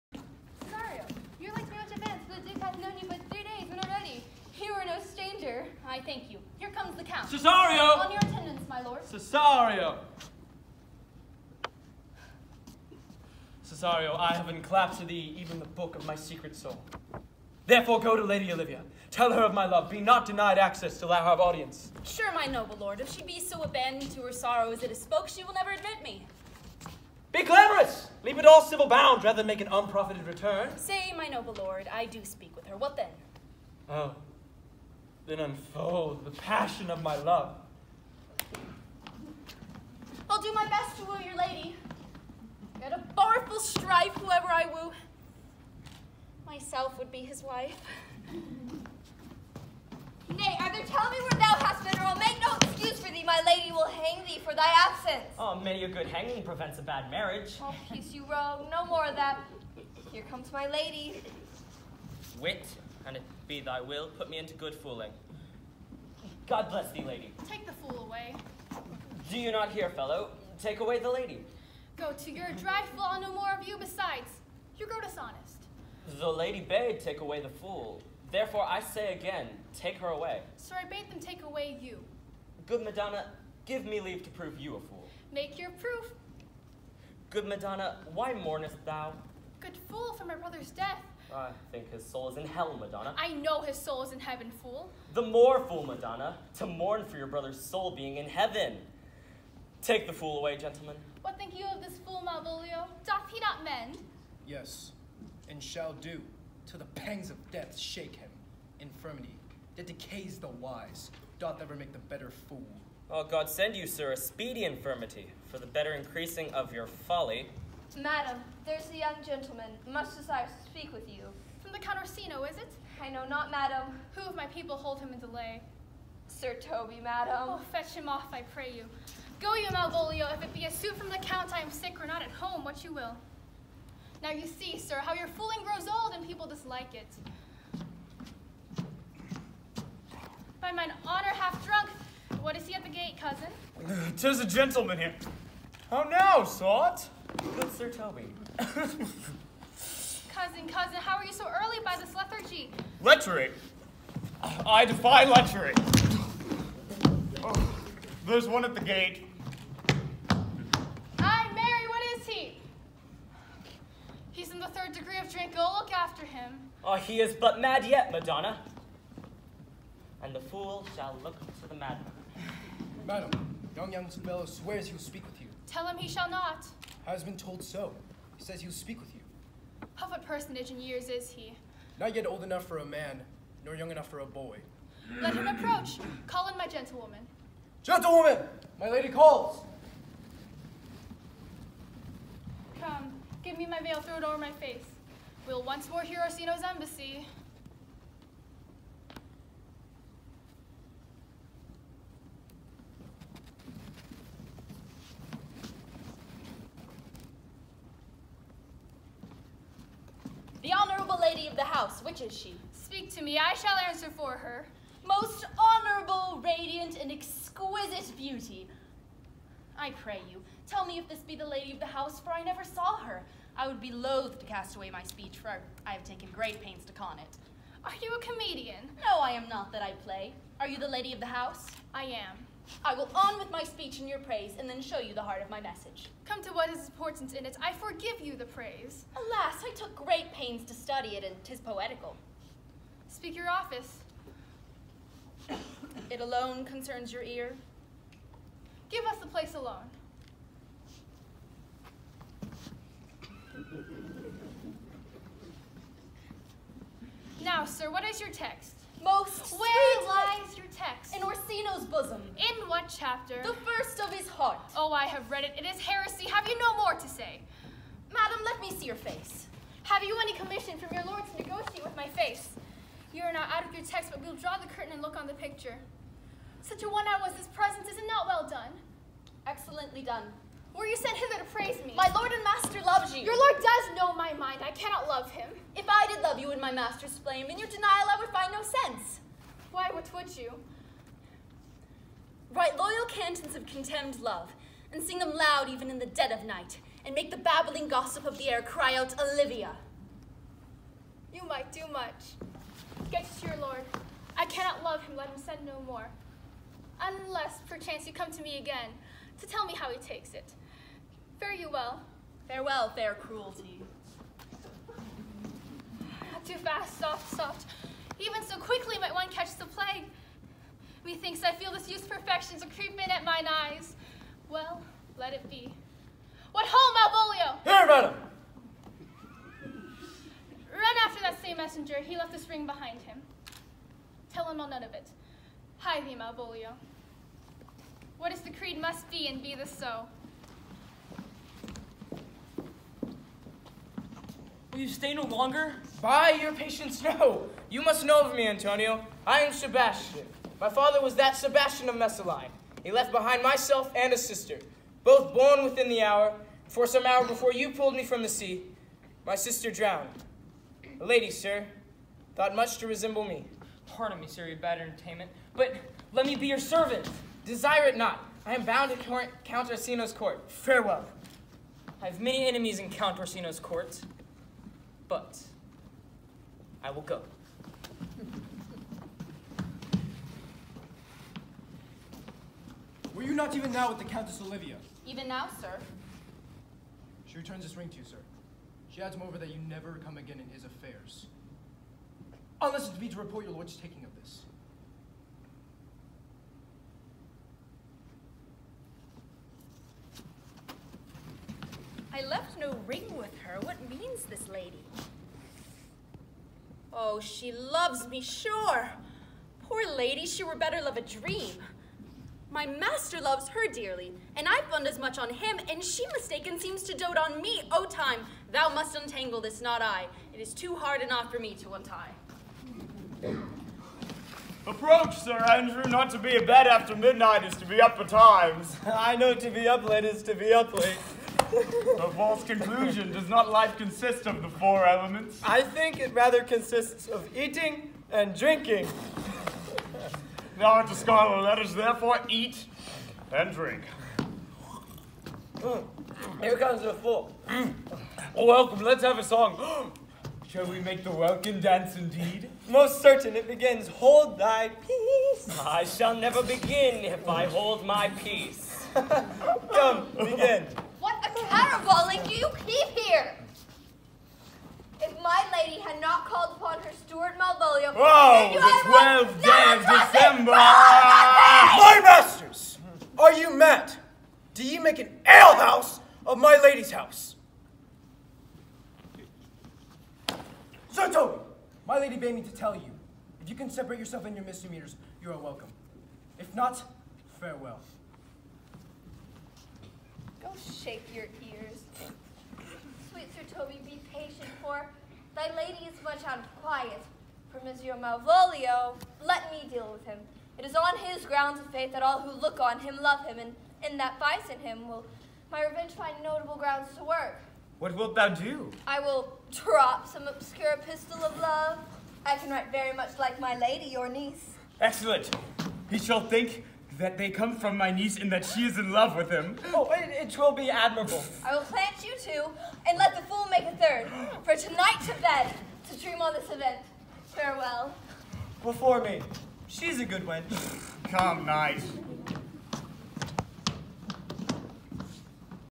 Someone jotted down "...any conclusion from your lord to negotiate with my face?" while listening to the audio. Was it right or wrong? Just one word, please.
wrong.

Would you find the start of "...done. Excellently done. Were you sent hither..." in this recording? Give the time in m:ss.
4:38.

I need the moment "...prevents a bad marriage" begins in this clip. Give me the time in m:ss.
0:56.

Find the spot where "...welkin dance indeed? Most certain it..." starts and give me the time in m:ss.
7:31.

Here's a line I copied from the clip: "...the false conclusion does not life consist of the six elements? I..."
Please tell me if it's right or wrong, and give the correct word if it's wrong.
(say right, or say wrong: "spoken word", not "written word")
wrong: "four", not "six".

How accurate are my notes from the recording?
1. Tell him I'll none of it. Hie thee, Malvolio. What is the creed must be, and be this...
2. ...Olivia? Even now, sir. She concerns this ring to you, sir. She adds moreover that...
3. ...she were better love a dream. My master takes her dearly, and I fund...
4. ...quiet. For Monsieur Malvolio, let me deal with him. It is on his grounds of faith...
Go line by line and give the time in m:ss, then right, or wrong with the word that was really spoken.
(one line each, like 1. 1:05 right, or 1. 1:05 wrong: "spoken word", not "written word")
1. 5:34 right
2. 6:24 wrong: "returns", not "concerns"
3. 6:50 wrong: "loves", not "takes"
4. 8:16 right.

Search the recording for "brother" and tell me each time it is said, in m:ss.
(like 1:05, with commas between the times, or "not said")
1:30, 1:37.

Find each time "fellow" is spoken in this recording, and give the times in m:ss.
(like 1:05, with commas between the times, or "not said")
1:09, 2:54.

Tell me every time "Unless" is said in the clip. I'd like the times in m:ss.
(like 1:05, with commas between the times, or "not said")
5:07, 6:32.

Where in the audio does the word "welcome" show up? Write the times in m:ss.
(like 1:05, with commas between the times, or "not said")
7:28, 8:05.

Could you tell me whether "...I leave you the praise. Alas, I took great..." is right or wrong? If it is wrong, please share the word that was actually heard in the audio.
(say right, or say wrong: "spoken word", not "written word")
wrong: "forgive", not "leave".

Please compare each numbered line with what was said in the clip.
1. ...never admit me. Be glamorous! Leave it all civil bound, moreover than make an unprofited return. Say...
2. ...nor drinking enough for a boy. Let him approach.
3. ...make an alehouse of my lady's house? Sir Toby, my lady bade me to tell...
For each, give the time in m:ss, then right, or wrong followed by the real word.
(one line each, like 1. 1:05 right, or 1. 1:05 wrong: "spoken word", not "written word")
1. 0:25 wrong: "rather", not "moreover"
2. 3:03 wrong: "young", not "drinking"
3. 7:54 right.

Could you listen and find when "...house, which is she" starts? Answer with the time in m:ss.
3:31.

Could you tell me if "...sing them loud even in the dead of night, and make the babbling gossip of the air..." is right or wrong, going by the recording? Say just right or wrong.
right.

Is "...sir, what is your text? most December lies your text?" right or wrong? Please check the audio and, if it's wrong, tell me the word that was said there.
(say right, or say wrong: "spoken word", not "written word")
wrong: "Where", not "December".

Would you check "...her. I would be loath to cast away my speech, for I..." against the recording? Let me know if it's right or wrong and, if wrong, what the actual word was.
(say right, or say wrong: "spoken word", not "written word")
right.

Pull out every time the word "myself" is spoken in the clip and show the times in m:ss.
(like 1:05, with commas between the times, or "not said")
0:46, 5:53.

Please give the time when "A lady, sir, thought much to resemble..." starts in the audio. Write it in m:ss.
6:01.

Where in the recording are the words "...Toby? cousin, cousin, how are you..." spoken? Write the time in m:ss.
2:27.